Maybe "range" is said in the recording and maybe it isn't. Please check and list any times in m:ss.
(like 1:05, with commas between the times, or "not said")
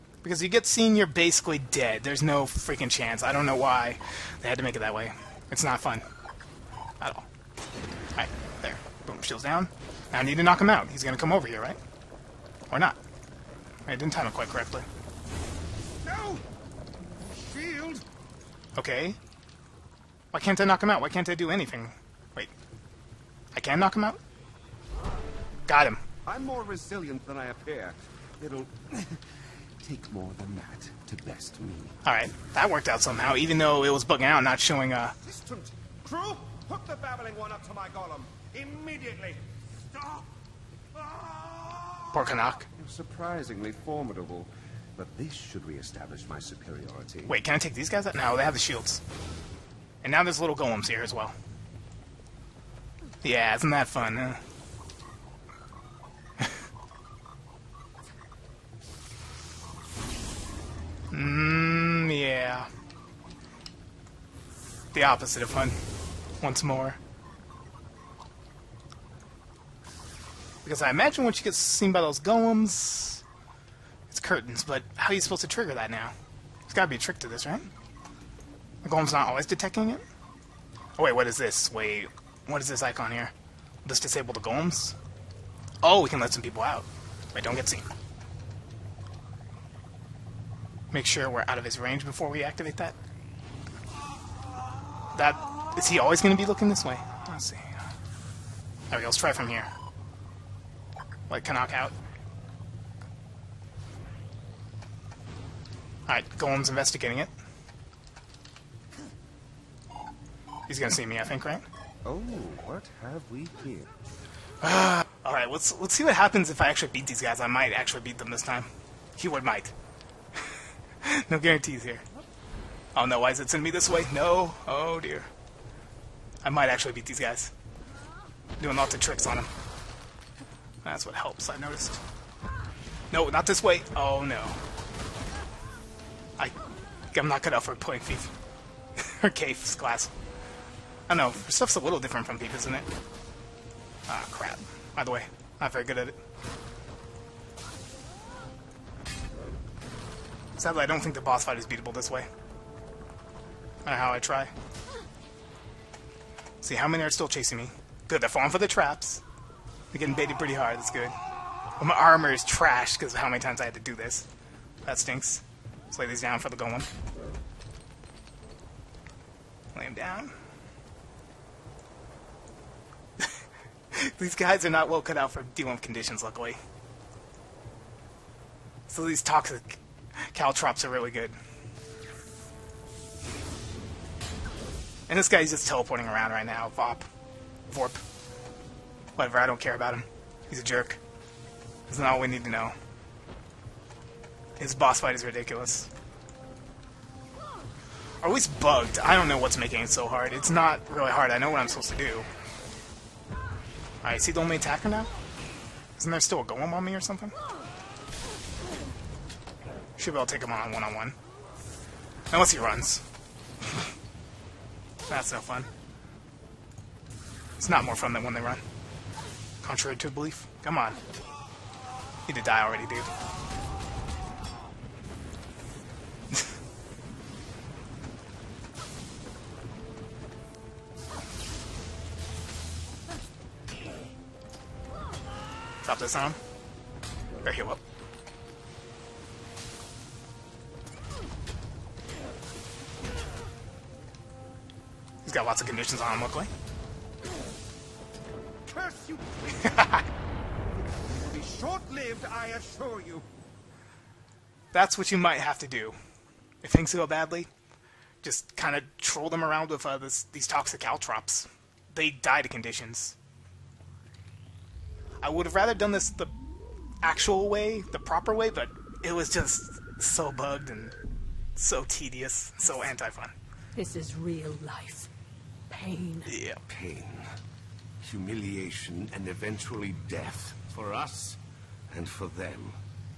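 1:31.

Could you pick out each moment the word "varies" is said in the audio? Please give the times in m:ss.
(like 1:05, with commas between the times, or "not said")
not said.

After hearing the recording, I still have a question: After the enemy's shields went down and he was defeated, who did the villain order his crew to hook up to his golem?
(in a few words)
The babbling one.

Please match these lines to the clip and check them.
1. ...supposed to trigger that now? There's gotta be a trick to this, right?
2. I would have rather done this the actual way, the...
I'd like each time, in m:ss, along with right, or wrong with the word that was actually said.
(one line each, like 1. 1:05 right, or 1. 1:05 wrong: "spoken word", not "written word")
1. 1:15 right
2. 4:25 right.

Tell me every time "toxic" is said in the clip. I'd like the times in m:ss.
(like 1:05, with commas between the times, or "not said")
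2:59, 4:20.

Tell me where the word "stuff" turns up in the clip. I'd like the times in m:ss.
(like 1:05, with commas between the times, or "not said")
2:21.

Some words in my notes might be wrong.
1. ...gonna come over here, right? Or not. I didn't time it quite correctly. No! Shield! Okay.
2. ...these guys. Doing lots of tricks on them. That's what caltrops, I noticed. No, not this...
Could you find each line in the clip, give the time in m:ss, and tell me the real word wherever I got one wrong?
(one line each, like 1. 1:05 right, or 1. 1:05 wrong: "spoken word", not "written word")
1. 0:11 right
2. 2:07 wrong: "helps", not "caltrops".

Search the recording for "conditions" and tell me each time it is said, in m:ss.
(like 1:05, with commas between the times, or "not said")
2:55, 4:05, 4:22.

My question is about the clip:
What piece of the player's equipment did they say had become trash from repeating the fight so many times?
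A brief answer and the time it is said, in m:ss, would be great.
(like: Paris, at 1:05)
Armor, at 2:41.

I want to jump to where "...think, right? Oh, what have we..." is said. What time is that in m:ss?
1:51.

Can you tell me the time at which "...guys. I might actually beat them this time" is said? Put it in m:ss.
1:57.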